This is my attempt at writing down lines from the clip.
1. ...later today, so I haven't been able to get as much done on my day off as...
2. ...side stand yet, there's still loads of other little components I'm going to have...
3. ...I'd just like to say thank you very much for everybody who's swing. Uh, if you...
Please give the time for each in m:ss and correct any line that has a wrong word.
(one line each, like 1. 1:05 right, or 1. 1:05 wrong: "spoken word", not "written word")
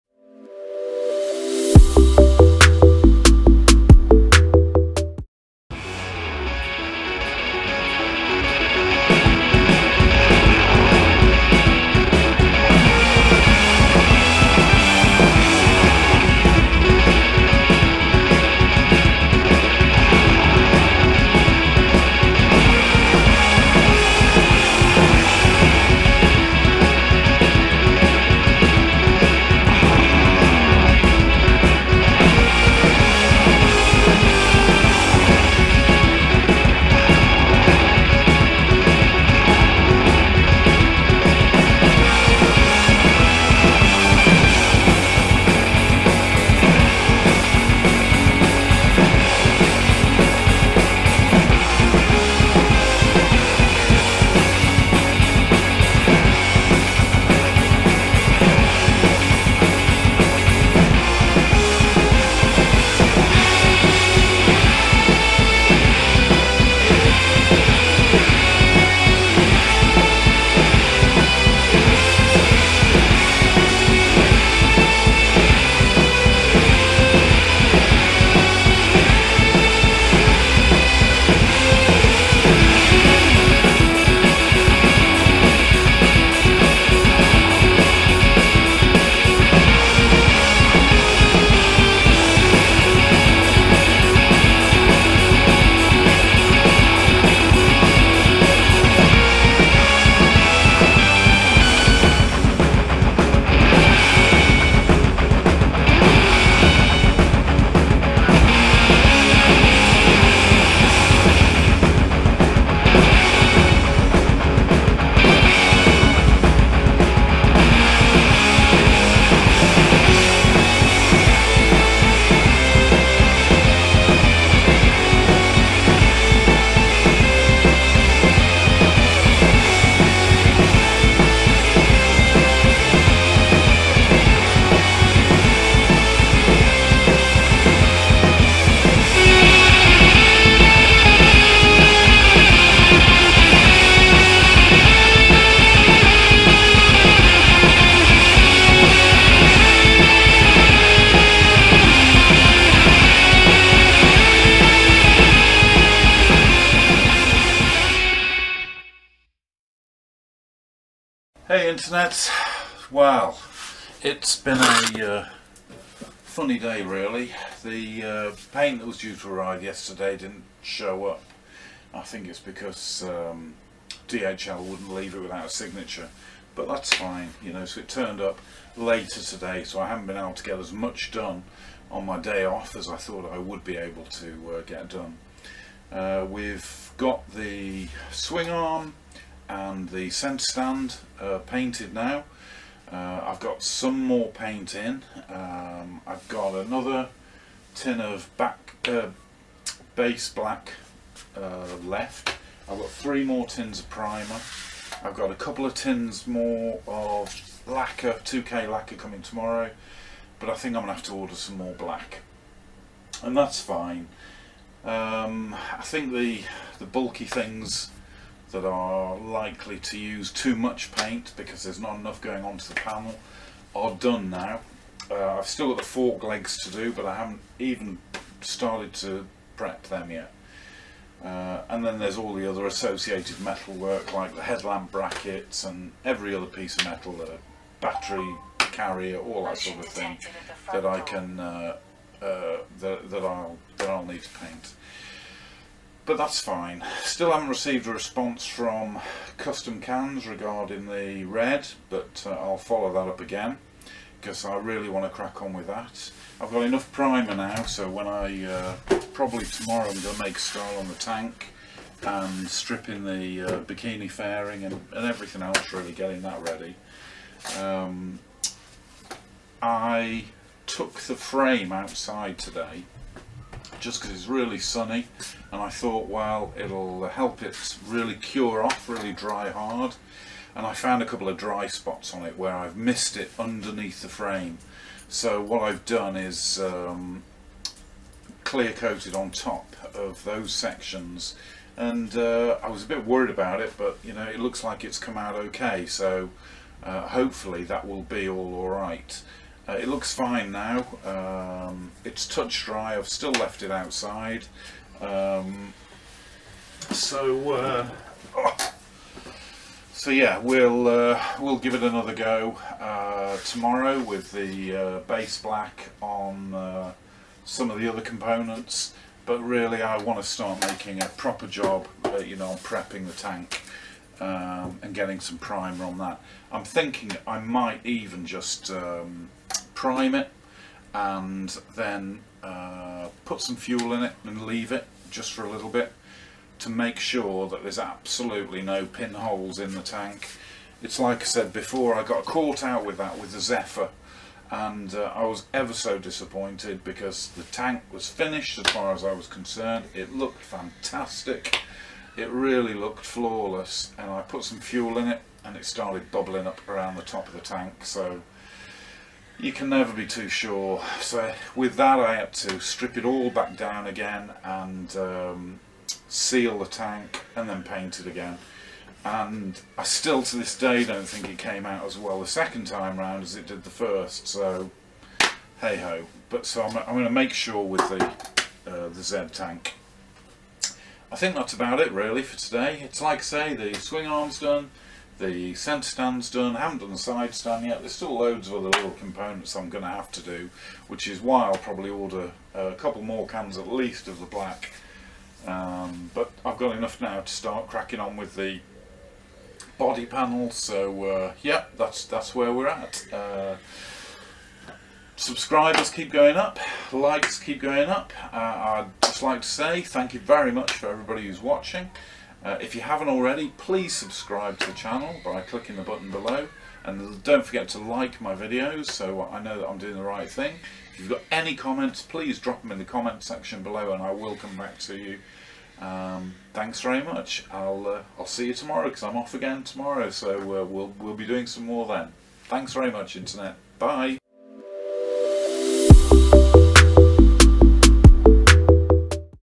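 1. 2:58 right
2. 6:26 right
3. 6:48 wrong: "watching", not "swing".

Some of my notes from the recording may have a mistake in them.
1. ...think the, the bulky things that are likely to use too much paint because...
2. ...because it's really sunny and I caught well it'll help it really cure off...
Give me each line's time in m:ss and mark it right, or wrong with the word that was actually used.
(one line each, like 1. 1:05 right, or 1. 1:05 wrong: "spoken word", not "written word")
1. 3:35 right
2. 4:34 wrong: "thought", not "caught".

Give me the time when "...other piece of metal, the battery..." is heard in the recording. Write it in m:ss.
3:56.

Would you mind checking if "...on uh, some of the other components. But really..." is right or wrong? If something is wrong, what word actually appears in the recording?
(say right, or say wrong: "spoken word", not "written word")
right.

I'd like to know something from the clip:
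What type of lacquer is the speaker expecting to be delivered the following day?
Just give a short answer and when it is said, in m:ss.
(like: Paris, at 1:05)
2K lacquer, at 3:28.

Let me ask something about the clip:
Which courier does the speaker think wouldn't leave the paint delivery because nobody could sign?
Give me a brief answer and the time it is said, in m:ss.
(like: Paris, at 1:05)
DHL, at 2:54.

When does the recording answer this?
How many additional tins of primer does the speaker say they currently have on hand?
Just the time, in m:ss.
3:22.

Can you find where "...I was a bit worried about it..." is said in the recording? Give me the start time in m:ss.
4:52.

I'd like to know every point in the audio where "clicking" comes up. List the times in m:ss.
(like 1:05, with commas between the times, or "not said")
6:55.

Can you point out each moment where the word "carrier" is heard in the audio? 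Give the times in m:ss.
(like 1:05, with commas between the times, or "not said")
3:58.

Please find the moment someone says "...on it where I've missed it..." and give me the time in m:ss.
4:42.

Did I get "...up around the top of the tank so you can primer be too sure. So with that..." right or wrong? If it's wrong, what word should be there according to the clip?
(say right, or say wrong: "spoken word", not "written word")
wrong: "never", not "primer".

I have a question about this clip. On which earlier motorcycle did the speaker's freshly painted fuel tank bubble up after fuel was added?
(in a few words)
Zephyr.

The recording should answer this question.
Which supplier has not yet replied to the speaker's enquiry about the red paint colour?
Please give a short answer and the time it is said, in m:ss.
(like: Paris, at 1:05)
Custom Cans, at 4:09.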